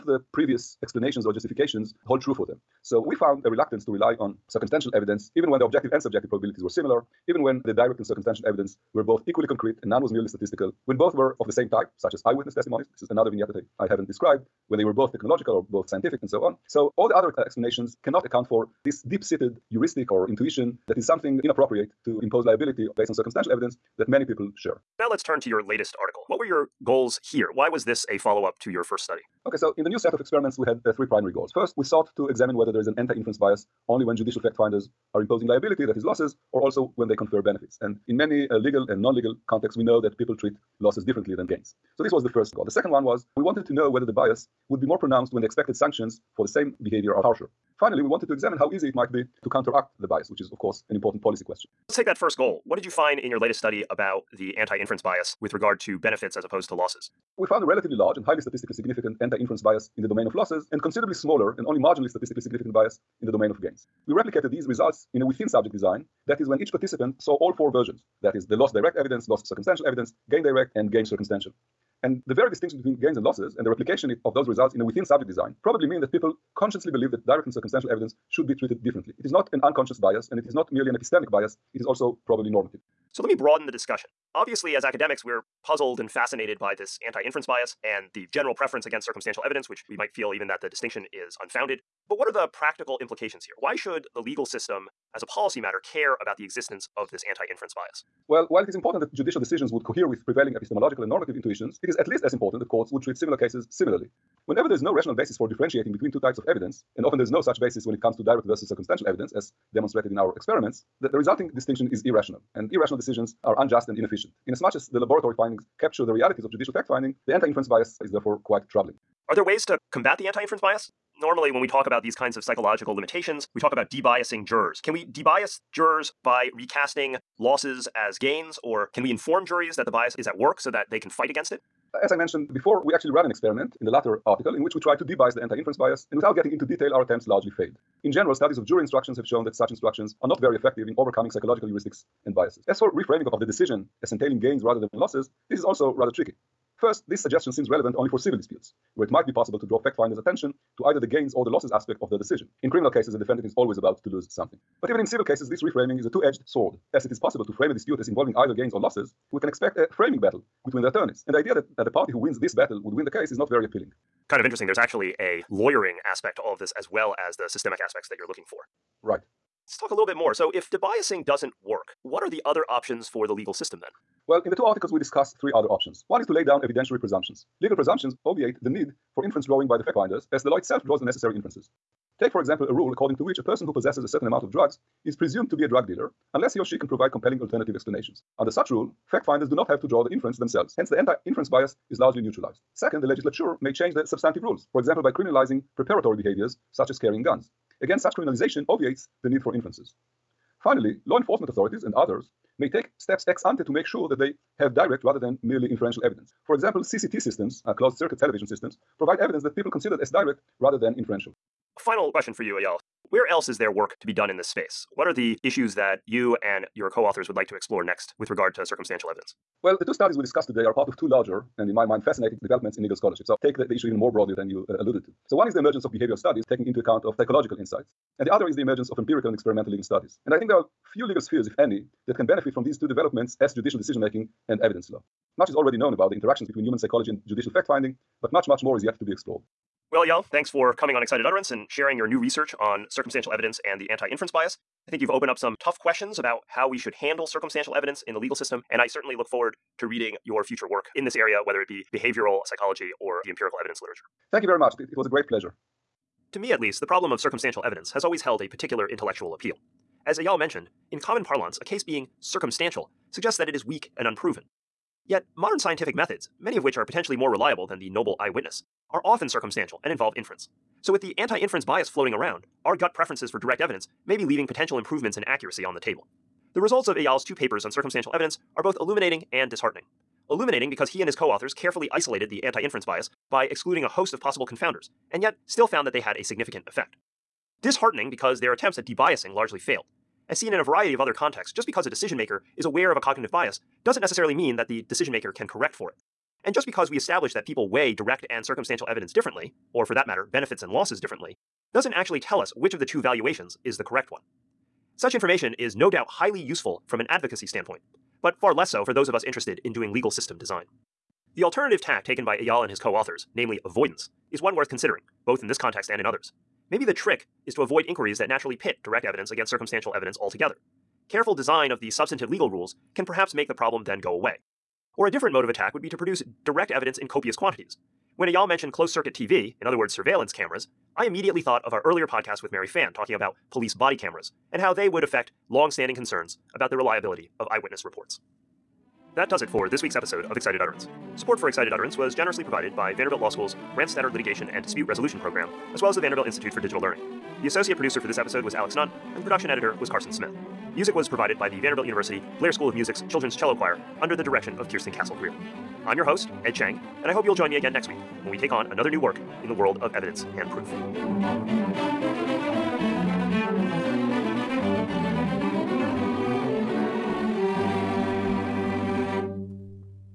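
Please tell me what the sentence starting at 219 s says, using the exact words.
Well, the two studies we discussed today are part of two larger and, in my mind, fascinating developments in legal scholarship.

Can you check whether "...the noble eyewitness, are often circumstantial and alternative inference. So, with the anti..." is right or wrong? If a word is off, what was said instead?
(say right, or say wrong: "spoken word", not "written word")
wrong: "involve", not "alternative".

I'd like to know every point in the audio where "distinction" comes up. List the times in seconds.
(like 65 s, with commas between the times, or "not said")
72 s, 90 s, 111 s.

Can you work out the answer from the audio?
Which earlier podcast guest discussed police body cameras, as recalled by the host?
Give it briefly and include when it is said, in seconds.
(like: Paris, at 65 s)
Mary Fan, at 332 s.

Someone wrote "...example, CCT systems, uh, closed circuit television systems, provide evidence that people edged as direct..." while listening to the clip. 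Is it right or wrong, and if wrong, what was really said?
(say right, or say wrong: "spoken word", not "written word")
wrong: "considered", not "edged".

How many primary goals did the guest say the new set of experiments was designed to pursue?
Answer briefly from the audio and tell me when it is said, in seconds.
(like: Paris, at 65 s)
3, at 30 s.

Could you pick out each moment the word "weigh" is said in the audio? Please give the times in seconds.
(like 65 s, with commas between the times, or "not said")
297 s.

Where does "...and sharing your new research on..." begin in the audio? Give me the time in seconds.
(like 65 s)
241 s.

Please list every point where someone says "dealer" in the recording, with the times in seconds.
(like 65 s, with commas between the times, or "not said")
185 s.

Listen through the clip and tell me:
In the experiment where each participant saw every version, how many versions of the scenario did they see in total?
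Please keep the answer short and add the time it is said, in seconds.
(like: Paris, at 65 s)
4, at 67 s.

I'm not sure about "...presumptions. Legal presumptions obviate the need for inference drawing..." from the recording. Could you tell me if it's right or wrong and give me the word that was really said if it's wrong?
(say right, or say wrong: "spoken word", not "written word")
right.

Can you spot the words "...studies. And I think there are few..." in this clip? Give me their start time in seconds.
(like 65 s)
229 s.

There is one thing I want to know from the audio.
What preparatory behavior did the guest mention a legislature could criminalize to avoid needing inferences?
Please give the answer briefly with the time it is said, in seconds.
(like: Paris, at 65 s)
Carrying guns, at 196 s.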